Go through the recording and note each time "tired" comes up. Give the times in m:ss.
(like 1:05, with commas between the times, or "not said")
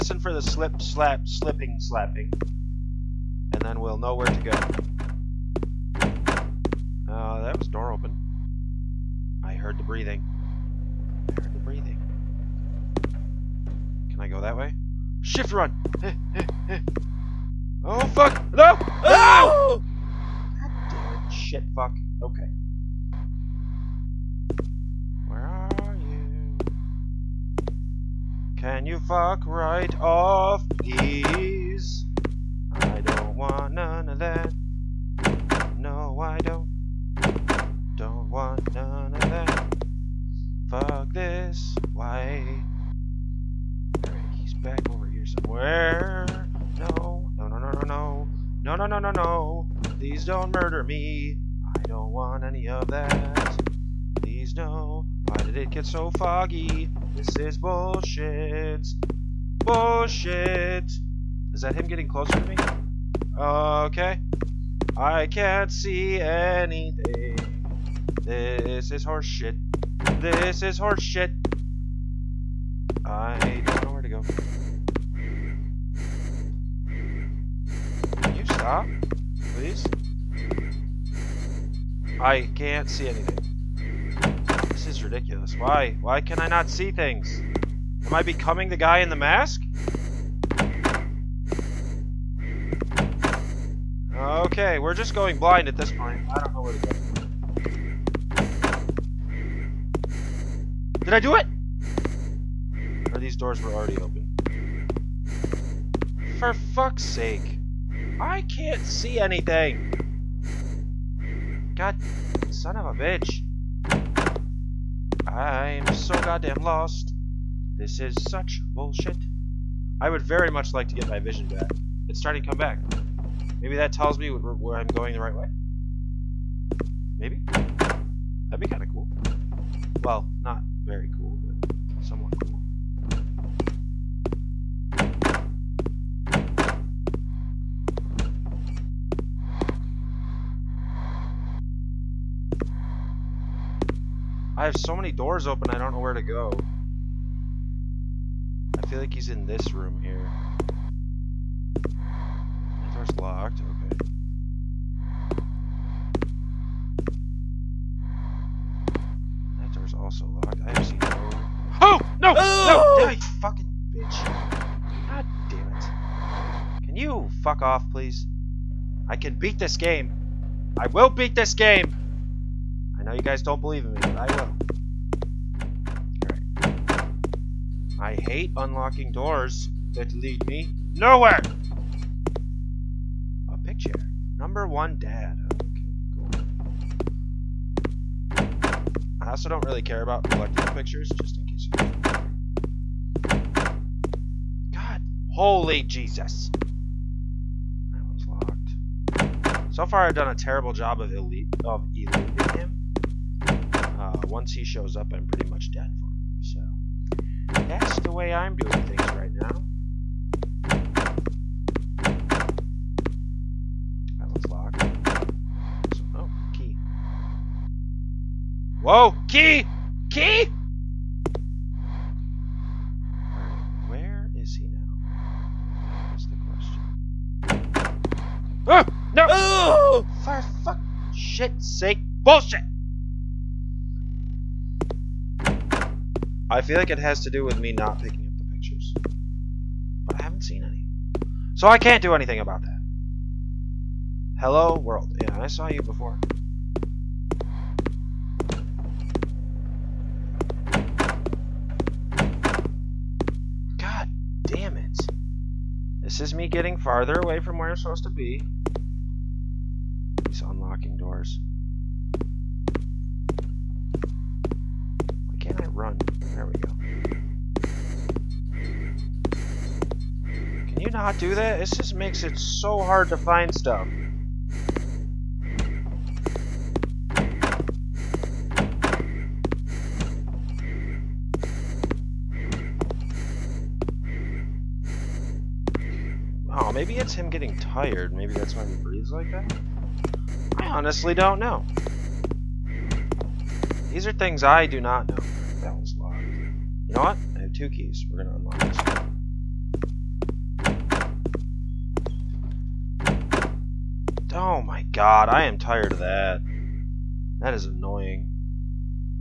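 4:47, 5:05.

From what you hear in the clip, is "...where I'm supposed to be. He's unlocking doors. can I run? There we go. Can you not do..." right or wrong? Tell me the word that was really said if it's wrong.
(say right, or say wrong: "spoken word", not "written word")
right.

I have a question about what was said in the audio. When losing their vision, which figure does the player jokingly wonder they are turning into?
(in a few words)
The guy in the mask.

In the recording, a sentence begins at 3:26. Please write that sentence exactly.
So that's the way I'm doing things right now.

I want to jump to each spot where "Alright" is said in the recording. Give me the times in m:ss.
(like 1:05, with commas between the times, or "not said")
0:44, 2:56.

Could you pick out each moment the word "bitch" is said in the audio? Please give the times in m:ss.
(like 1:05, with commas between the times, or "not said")
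1:52, 2:43.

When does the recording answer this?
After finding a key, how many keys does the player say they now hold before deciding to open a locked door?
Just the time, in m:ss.
4:57.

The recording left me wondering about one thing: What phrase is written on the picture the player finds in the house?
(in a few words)
Number one dad.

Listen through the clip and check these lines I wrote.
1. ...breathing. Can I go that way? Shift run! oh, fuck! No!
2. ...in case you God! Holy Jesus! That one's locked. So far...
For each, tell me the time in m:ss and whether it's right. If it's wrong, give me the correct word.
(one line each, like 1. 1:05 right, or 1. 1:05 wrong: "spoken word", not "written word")
1. 0:11 right
2. 3:11 right.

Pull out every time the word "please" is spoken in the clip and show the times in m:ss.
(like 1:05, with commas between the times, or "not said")
0:30, 0:49, 0:54, 1:19, 2:47.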